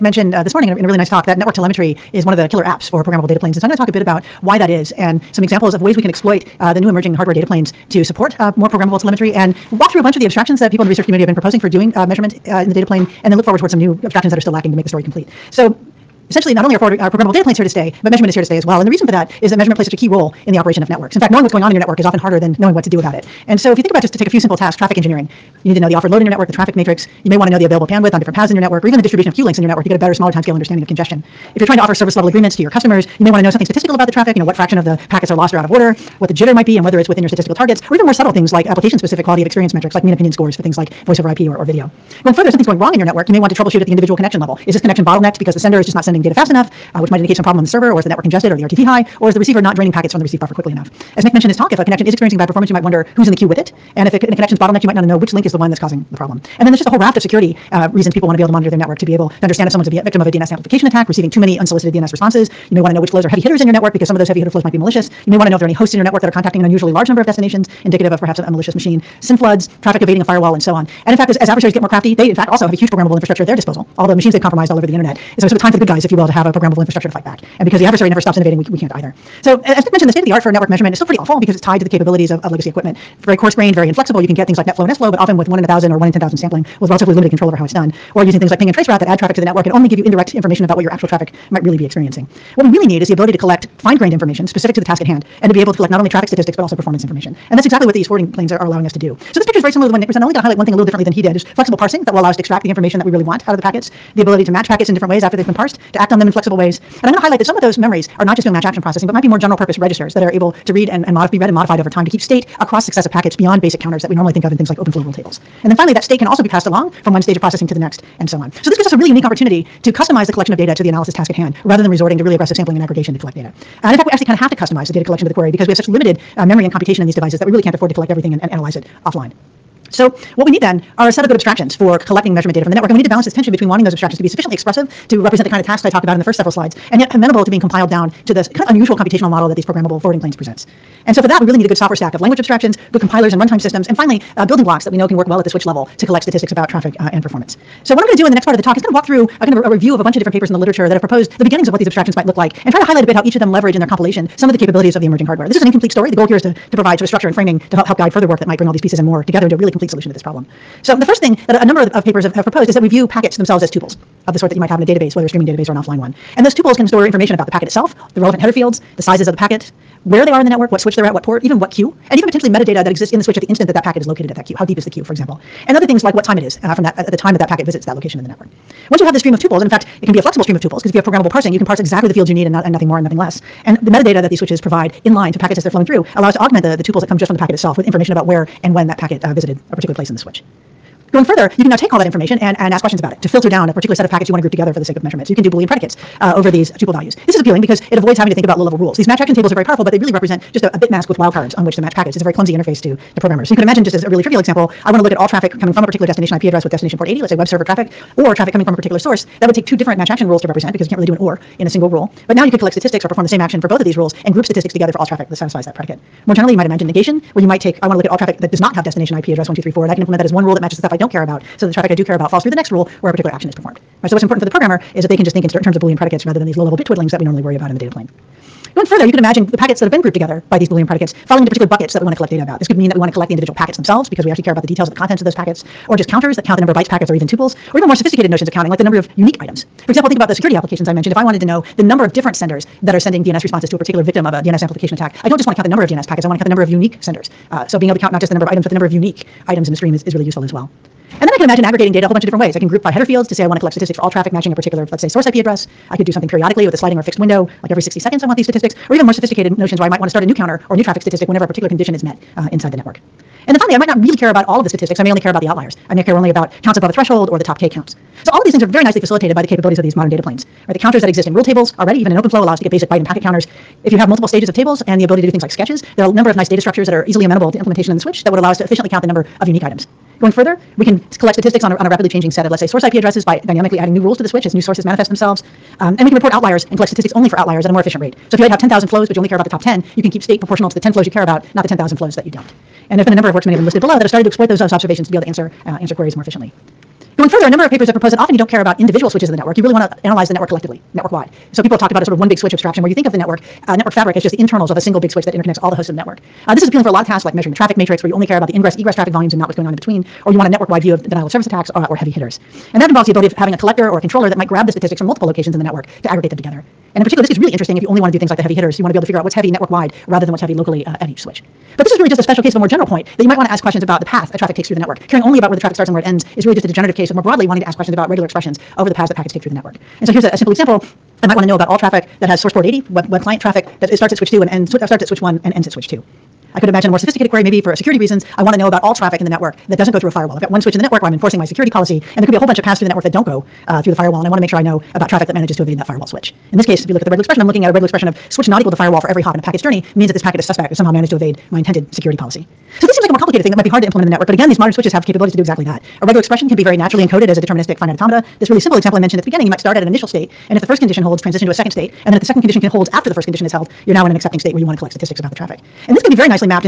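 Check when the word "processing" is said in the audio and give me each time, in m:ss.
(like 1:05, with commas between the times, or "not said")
1:48, 1:57.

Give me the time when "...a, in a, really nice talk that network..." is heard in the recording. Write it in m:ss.
0:00.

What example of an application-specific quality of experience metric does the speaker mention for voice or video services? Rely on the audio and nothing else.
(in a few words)
mean opinion scores.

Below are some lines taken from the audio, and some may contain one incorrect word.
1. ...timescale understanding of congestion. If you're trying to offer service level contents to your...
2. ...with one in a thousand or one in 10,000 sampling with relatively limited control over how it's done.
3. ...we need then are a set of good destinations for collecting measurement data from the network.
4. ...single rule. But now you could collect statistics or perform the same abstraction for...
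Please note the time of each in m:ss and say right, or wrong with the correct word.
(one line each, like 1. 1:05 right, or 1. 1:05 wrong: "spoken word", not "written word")
1. 0:30 wrong: "agreements", not "contents"
2. 1:25 right
3. 2:10 wrong: "abstractions", not "destinations"
4. 3:31 wrong: "action", not "abstraction".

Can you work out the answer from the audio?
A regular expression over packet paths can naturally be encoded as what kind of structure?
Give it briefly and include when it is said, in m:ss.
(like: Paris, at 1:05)
deterministic finite automata, at 5:57.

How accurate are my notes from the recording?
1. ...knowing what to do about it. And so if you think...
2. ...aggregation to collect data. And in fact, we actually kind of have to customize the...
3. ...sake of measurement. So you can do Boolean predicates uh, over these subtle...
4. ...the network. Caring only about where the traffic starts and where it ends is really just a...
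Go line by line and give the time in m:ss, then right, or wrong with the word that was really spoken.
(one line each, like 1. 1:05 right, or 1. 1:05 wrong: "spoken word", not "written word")
1. 0:22 right
2. 2:02 right
3. 3:14 wrong: "tuple", not "subtle"
4. 5:24 right.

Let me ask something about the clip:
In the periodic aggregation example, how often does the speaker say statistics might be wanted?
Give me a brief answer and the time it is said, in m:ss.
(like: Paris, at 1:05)
every 60 seconds, at 4:17.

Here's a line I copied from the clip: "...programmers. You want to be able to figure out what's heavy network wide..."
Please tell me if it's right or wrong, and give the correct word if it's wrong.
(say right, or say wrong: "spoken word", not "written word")
wrong: "hitters", not "programmers".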